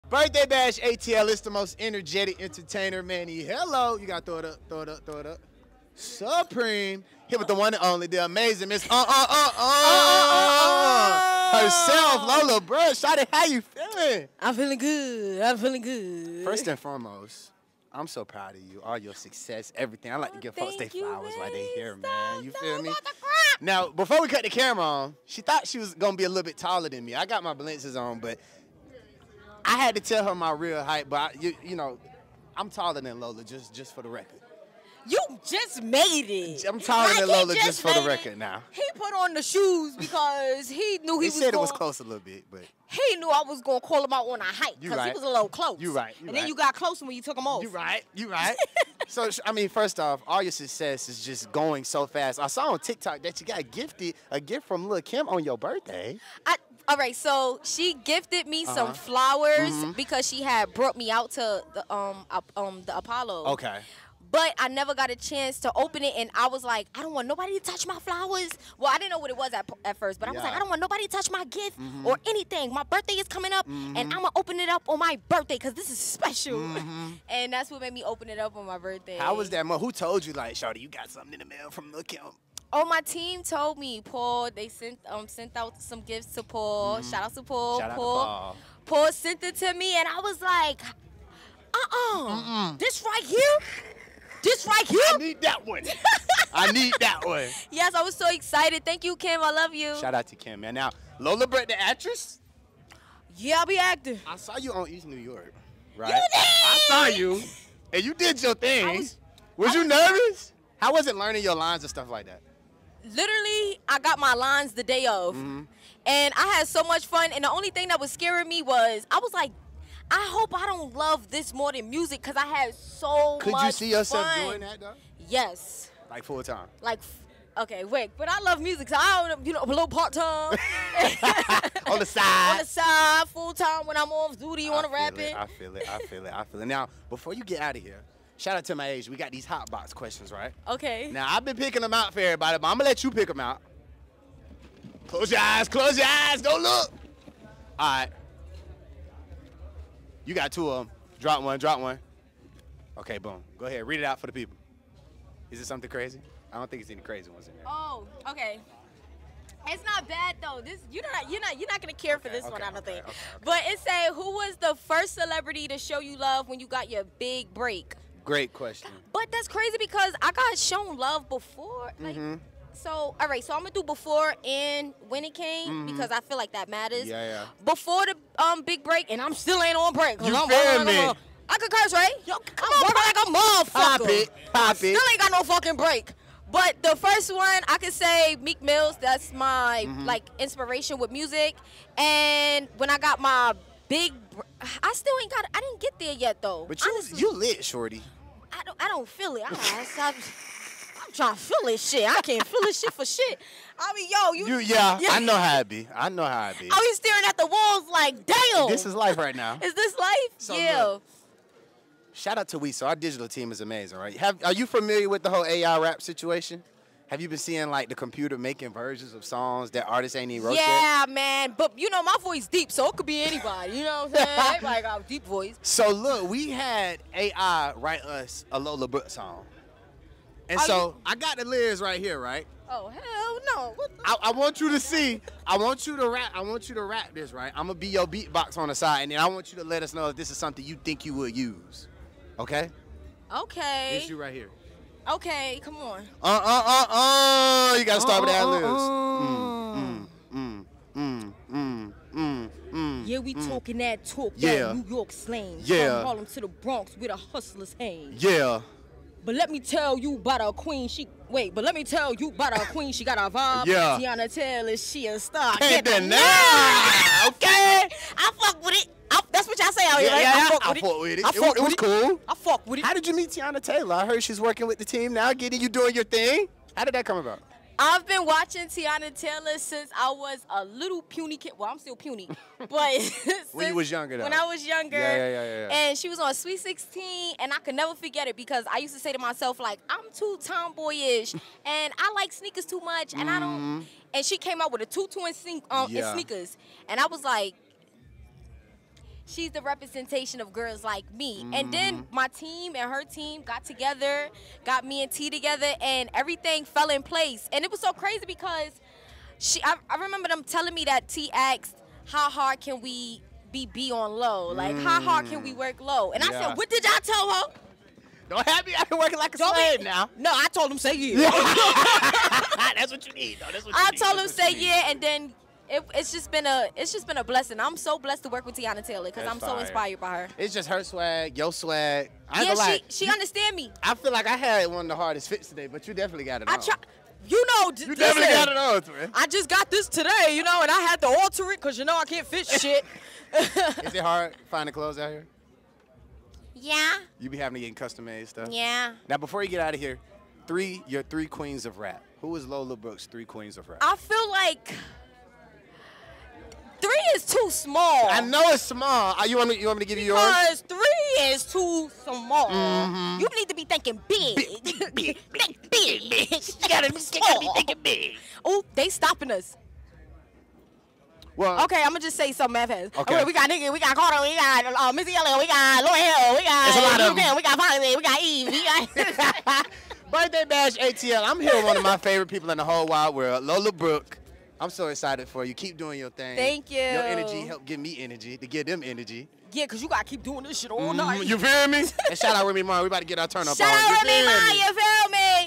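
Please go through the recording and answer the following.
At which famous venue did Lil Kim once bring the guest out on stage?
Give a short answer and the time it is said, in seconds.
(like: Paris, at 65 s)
The Apollo, at 62 s.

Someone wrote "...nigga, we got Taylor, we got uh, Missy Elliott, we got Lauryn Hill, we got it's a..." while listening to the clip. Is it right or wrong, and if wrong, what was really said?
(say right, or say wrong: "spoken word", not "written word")
wrong: "Carter", not "Taylor".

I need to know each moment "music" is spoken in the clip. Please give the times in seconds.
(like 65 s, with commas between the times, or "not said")
121 s, 128 s, 191 s.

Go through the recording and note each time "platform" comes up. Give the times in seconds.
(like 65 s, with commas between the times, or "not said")
not said.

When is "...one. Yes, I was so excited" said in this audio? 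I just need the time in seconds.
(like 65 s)
97 s.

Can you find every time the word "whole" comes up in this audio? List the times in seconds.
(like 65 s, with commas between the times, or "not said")
215 s, 382 s.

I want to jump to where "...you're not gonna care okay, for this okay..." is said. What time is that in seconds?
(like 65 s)
161 s.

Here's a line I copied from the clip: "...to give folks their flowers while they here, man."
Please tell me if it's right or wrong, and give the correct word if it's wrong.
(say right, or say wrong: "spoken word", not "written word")
right.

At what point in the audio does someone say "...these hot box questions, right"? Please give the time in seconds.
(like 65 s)
139 s.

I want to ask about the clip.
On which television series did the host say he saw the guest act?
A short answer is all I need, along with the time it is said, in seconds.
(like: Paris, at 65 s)
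East New York, at 104 s.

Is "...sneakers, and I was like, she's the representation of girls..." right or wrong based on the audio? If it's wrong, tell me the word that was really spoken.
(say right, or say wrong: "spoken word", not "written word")
right.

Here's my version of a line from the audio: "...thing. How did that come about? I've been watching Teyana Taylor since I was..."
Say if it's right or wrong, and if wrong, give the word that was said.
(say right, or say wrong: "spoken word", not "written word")
right.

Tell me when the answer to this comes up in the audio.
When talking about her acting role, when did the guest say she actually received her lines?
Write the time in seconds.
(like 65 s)
114 s.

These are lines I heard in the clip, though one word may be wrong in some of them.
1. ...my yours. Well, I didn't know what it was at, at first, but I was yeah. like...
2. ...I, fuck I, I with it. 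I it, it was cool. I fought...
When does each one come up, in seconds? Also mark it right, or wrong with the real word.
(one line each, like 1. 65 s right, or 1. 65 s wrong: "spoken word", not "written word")
1. 67 s wrong: "flowers", not "yours"
2. 270 s right.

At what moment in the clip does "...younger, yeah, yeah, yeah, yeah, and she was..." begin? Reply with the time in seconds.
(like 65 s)
284 s.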